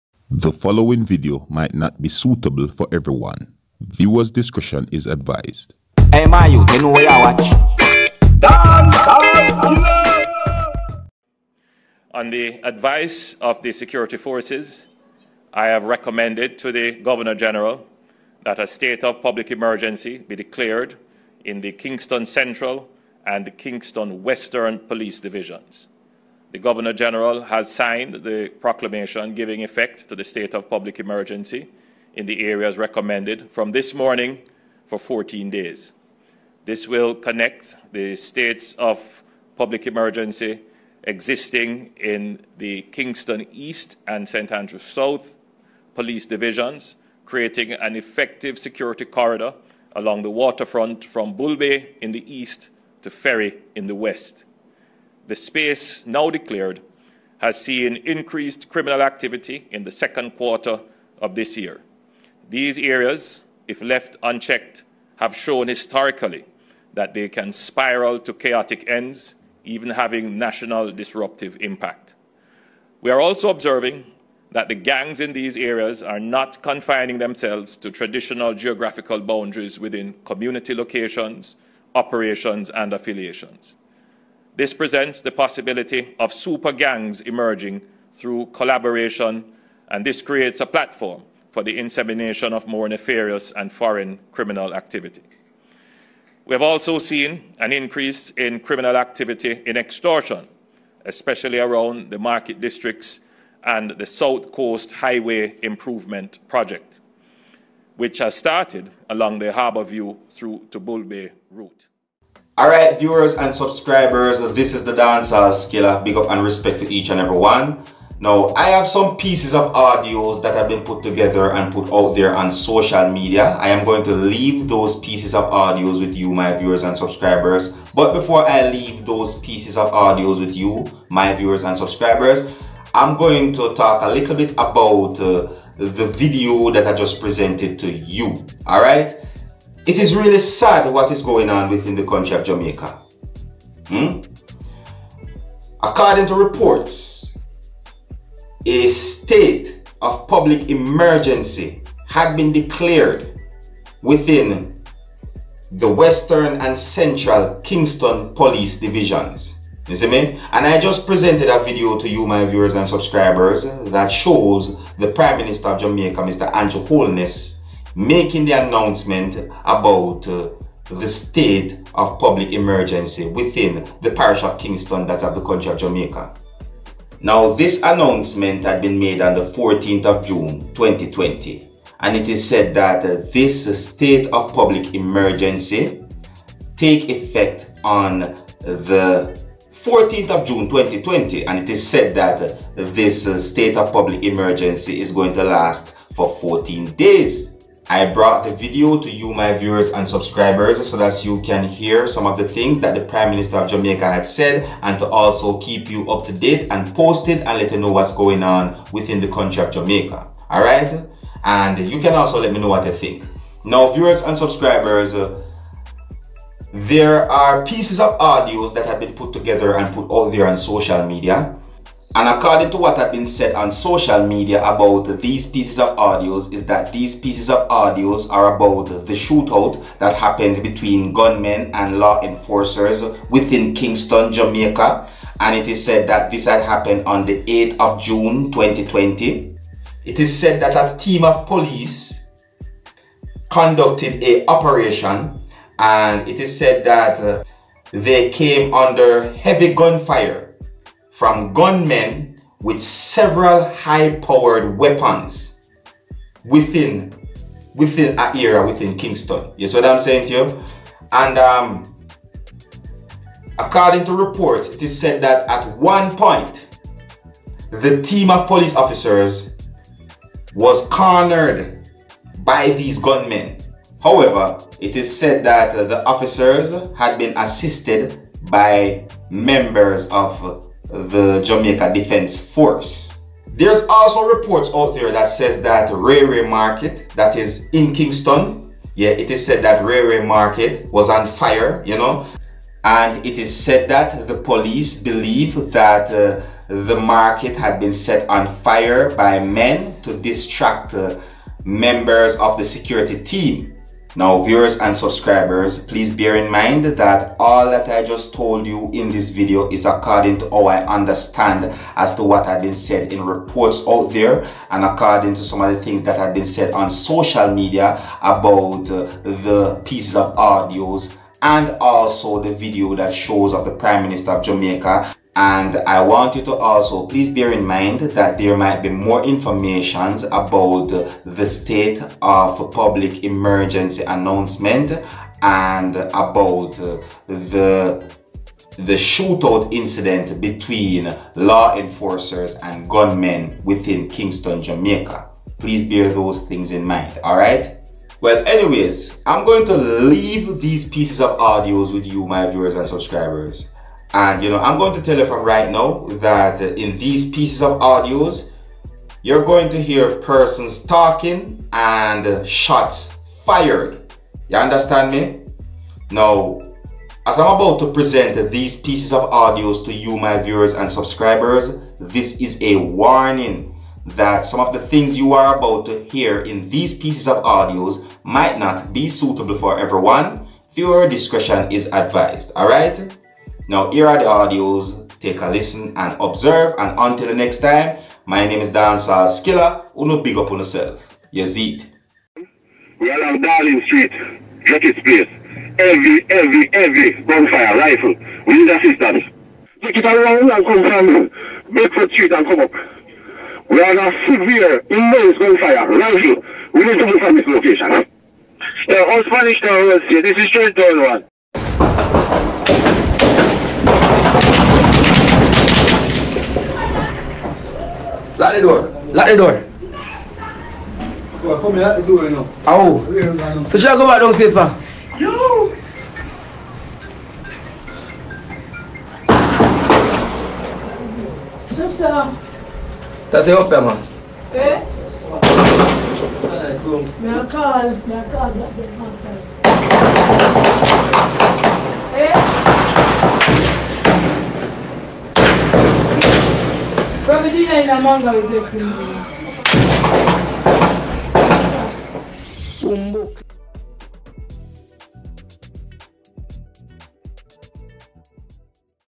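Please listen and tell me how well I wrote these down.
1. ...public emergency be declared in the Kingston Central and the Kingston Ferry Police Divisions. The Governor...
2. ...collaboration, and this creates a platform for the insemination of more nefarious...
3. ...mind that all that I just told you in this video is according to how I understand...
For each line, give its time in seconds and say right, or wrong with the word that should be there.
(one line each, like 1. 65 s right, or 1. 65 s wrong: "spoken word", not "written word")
1. 19 s wrong: "Western", not "Ferry"
2. 88 s right
3. 306 s right.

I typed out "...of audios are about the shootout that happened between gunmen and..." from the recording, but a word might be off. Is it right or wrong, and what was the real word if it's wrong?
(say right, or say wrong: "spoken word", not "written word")
right.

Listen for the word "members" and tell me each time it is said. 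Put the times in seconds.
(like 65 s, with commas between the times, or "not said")
279 s, 301 s.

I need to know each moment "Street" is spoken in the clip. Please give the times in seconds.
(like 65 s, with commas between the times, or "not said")
393 s, 402 s.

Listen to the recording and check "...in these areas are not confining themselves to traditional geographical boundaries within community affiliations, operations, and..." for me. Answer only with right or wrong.
wrong.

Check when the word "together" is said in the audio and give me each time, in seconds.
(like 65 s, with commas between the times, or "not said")
121 s, 219 s.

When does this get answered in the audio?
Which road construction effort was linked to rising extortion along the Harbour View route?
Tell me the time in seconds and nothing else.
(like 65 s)
104 s.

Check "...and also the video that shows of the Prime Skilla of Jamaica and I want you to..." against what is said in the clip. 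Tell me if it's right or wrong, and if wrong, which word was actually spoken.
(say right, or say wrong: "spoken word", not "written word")
wrong: "Minister", not "Skilla".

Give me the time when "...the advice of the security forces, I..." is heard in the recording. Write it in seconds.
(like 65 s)
12 s.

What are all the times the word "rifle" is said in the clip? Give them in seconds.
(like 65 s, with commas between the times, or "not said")
397 s, 405 s.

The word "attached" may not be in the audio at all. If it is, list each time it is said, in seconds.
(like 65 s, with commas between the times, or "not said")
not said.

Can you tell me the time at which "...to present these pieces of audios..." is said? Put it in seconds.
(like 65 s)
367 s.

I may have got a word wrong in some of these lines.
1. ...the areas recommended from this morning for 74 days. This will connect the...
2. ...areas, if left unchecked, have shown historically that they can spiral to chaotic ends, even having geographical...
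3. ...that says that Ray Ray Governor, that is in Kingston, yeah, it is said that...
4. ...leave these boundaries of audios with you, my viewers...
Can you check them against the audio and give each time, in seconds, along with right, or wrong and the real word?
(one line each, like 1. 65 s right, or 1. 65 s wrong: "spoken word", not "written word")
1. 32 s wrong: "14", not "74"
2. 62 s wrong: "national", not "geographical"
3. 285 s wrong: "Market", not "Governor"
4. 349 s wrong: "pieces", not "boundaries".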